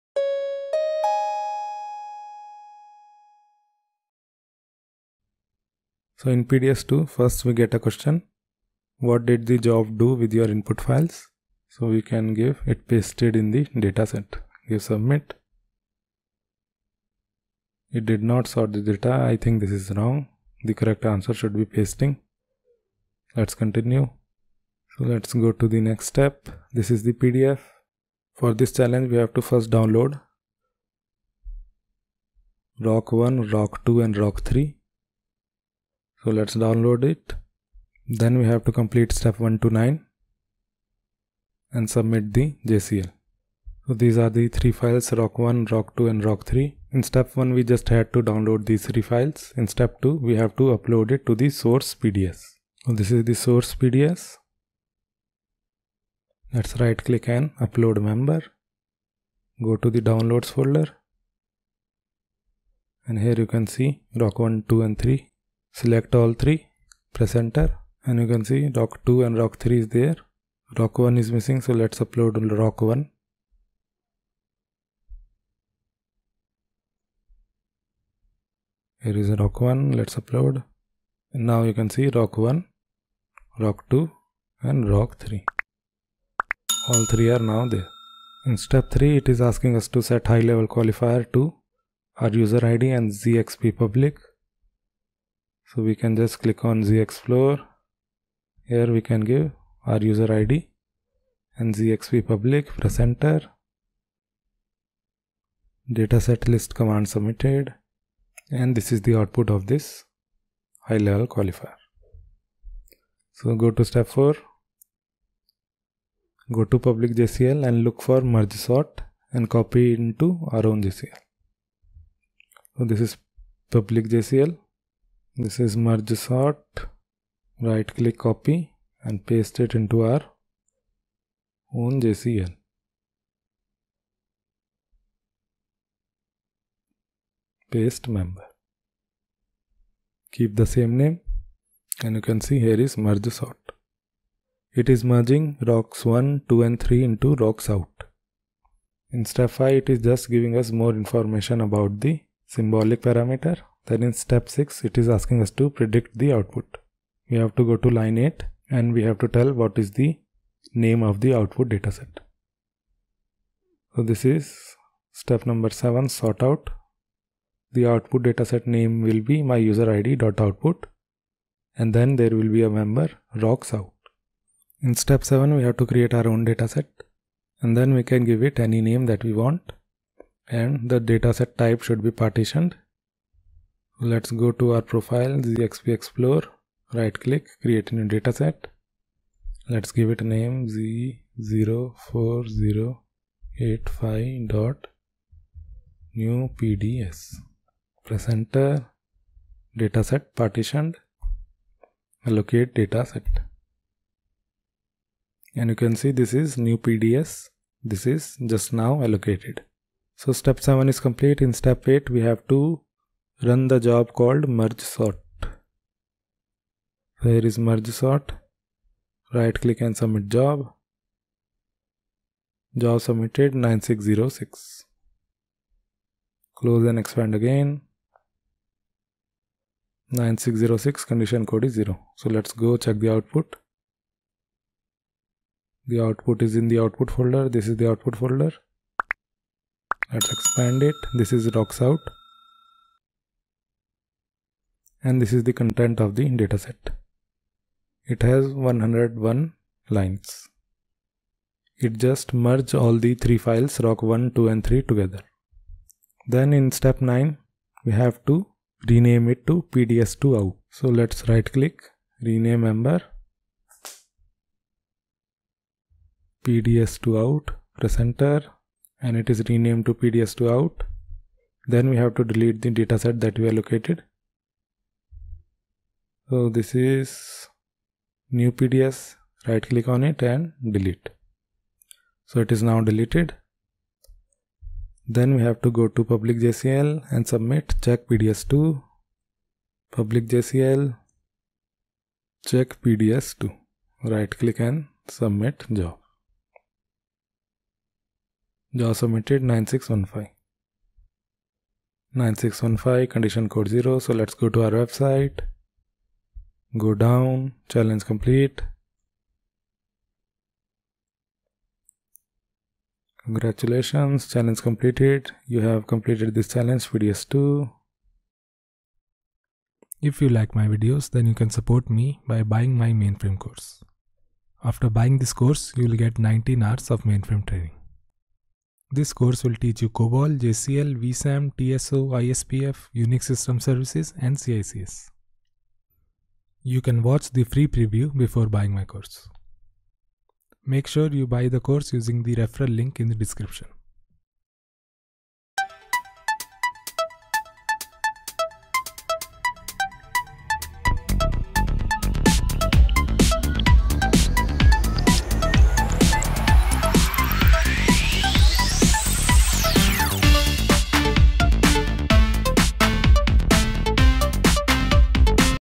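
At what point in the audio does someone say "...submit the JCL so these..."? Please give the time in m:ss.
0:41.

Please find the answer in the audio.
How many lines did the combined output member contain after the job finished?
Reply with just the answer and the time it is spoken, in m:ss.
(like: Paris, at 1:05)
101, at 4:08.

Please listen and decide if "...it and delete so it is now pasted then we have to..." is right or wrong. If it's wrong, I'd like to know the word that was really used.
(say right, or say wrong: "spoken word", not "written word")
wrong: "deleted", not "pasted".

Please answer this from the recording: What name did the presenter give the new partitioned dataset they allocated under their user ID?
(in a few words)
Z04085.NEW.PDS.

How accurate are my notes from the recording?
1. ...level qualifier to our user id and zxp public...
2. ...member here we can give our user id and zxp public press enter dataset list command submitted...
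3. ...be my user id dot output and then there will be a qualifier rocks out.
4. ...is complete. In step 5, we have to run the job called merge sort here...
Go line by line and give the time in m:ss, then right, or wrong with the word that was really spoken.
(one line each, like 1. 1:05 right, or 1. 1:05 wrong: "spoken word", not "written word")
1. 1:30 right
2. 1:37 wrong: "explorer", not "member"
3. 2:49 wrong: "member", not "qualifier"
4. 3:30 wrong: "8", not "5".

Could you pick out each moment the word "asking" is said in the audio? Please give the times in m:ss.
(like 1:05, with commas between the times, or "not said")
1:29, 2:35.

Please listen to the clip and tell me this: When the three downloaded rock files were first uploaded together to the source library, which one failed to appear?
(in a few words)
Rock 1.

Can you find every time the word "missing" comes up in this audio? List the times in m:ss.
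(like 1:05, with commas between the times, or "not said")
1:11.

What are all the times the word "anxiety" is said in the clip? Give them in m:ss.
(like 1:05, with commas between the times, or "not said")
not said.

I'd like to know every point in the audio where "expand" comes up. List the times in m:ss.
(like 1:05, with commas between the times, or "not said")
3:47, 4:00.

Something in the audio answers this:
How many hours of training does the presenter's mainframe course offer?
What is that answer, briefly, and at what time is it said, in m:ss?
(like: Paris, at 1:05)
19 hours, at 5:26.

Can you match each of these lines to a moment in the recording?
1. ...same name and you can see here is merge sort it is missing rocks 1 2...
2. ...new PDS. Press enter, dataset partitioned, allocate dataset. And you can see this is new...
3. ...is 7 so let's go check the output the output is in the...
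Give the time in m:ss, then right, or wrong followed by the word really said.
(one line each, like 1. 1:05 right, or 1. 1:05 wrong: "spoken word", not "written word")
1. 2:20 wrong: "merging", not "missing"
2. 3:16 right
3. 3:51 wrong: "0", not "7".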